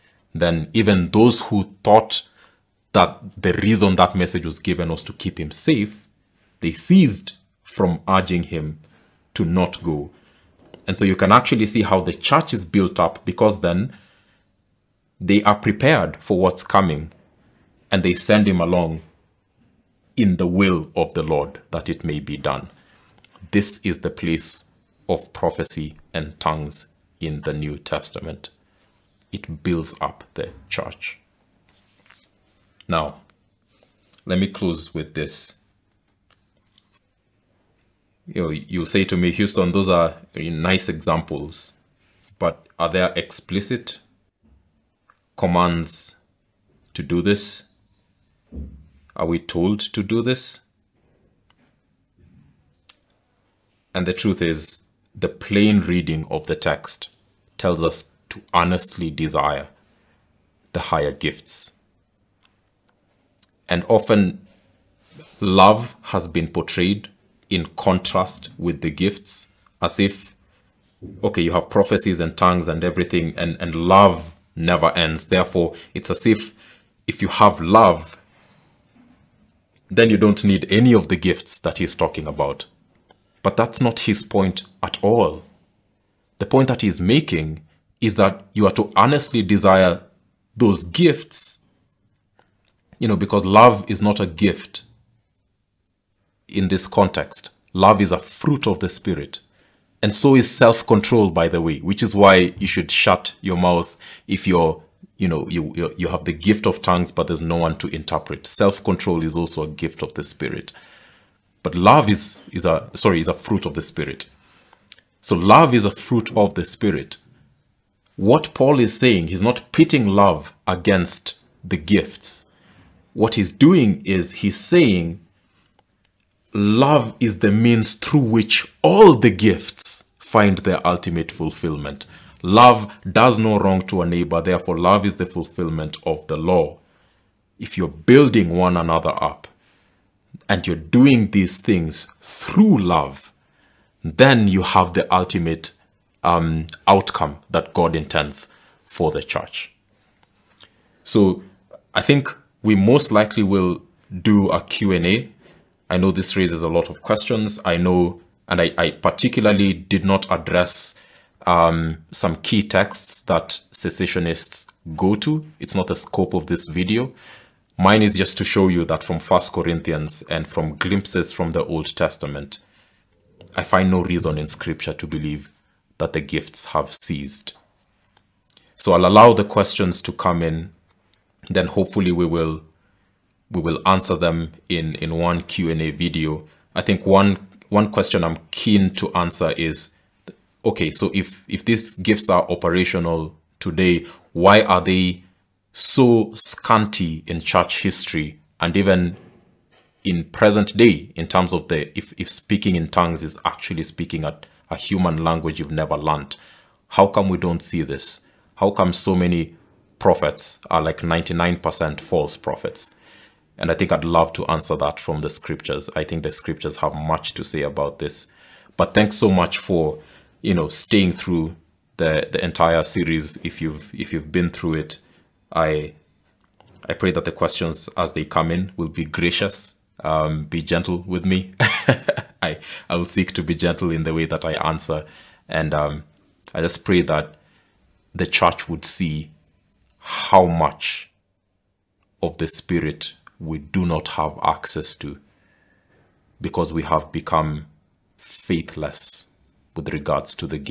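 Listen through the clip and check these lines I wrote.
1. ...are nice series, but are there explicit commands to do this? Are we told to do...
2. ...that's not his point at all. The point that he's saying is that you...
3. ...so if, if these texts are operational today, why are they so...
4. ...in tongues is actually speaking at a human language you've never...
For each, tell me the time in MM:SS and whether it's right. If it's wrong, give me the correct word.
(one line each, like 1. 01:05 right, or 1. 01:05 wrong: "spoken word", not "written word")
1. 00:39 wrong: "examples", not "series"
2. 01:23 wrong: "making", not "saying"
3. 03:10 wrong: "gifts", not "texts"
4. 03:22 right.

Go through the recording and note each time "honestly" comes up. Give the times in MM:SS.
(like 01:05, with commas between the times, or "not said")
00:58, 01:28.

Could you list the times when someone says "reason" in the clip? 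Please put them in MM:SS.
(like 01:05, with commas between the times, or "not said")
00:03, 02:54.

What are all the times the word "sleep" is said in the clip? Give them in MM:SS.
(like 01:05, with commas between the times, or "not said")
not said.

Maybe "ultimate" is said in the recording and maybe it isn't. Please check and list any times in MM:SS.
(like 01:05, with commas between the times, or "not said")
02:10, 02:25.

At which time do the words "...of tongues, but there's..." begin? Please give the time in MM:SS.
01:46.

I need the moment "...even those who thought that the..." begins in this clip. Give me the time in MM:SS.
00:00.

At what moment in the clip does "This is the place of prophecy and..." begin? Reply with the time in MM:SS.
00:23.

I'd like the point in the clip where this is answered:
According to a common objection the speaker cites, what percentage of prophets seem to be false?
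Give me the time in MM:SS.
03:30.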